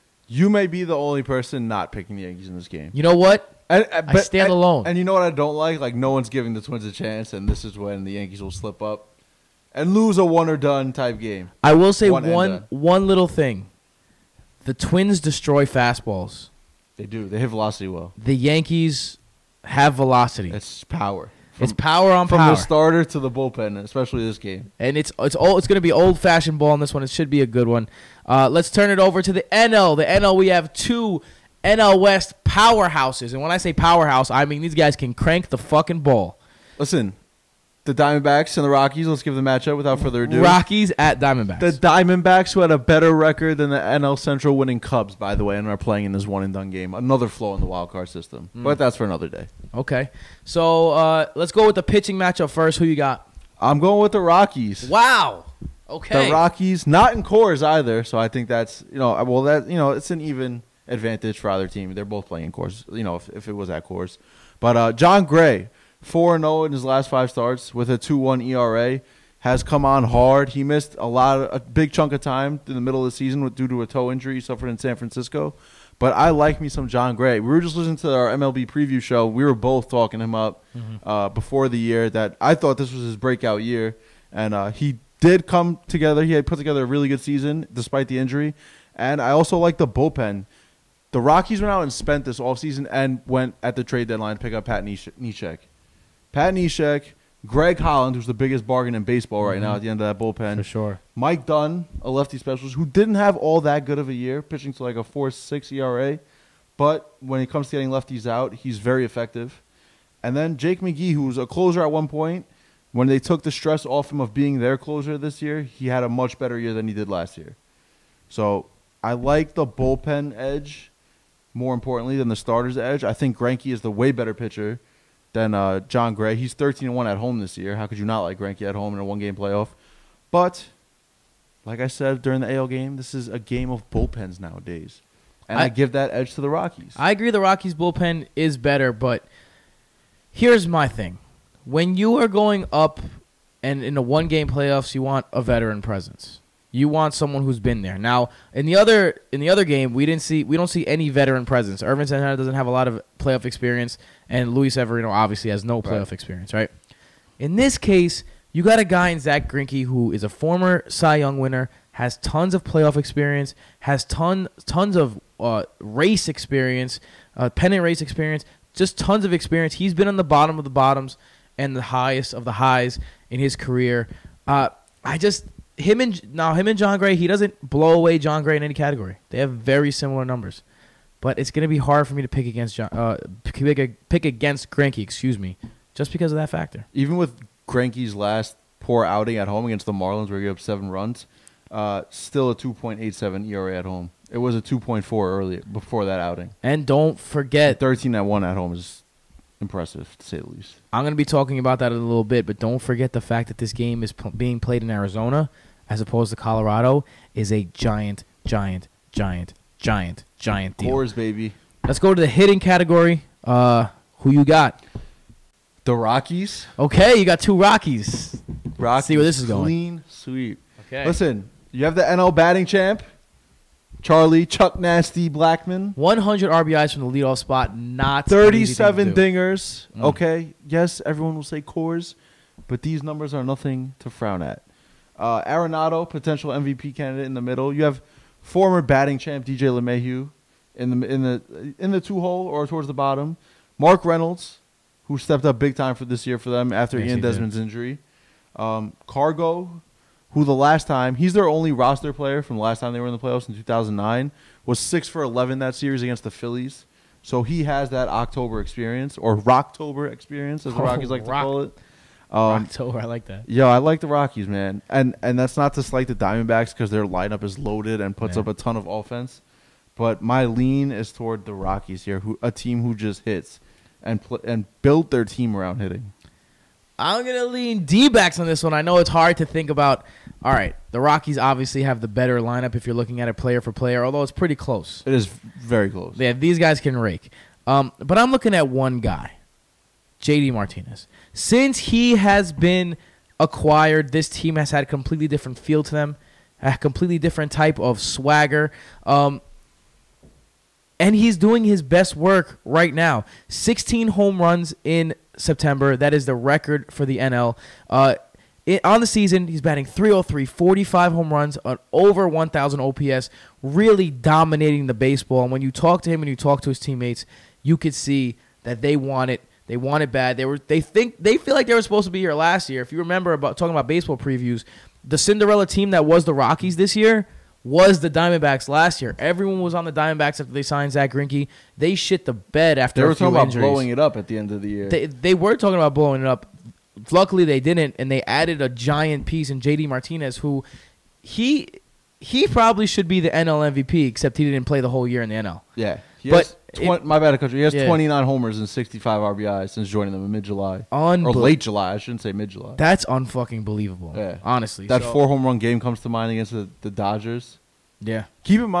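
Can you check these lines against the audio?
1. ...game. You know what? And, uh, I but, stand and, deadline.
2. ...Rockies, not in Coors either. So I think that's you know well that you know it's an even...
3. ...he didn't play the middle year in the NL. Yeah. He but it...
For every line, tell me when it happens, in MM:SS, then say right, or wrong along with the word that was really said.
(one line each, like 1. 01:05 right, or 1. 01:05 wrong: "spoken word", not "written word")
1. 00:02 wrong: "alone", not "deadline"
2. 00:56 right
3. 05:44 wrong: "whole", not "middle".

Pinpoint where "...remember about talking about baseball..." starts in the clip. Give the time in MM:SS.
05:22.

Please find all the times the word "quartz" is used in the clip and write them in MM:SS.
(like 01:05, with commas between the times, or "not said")
not said.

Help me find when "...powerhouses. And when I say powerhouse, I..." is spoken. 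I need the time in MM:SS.
00:32.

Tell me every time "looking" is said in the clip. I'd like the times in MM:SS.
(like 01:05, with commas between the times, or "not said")
04:42, 04:48.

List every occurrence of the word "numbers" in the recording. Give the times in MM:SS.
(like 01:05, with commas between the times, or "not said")
03:00, 03:53.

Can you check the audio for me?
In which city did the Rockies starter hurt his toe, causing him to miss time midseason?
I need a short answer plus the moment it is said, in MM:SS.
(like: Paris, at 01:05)
San Francisco, at 01:14.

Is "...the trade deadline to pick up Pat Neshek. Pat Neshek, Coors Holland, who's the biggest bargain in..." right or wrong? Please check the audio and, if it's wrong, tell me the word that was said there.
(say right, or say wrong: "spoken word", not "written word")
wrong: "Greg", not "Coors".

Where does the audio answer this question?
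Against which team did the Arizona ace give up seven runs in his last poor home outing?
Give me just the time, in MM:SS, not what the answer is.
03:09.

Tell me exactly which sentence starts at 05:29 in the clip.
Everyone was on the Diamondbacks after they signed Zack Greinke.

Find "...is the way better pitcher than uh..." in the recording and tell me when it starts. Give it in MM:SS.
02:03.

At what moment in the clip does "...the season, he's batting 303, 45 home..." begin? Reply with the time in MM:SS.
05:08.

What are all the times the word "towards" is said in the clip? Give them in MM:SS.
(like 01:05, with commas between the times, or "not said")
04:02, 04:31.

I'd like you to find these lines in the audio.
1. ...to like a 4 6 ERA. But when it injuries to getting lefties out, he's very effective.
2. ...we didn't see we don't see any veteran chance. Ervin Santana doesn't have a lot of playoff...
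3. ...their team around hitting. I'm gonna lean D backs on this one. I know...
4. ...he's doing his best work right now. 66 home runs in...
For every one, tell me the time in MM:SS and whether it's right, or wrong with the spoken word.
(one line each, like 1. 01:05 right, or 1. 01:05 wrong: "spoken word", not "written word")
1. 01:44 wrong: "comes", not "injuries"
2. 02:29 wrong: "presence", not "chance"
3. 04:35 right
4. 05:01 wrong: "16", not "66".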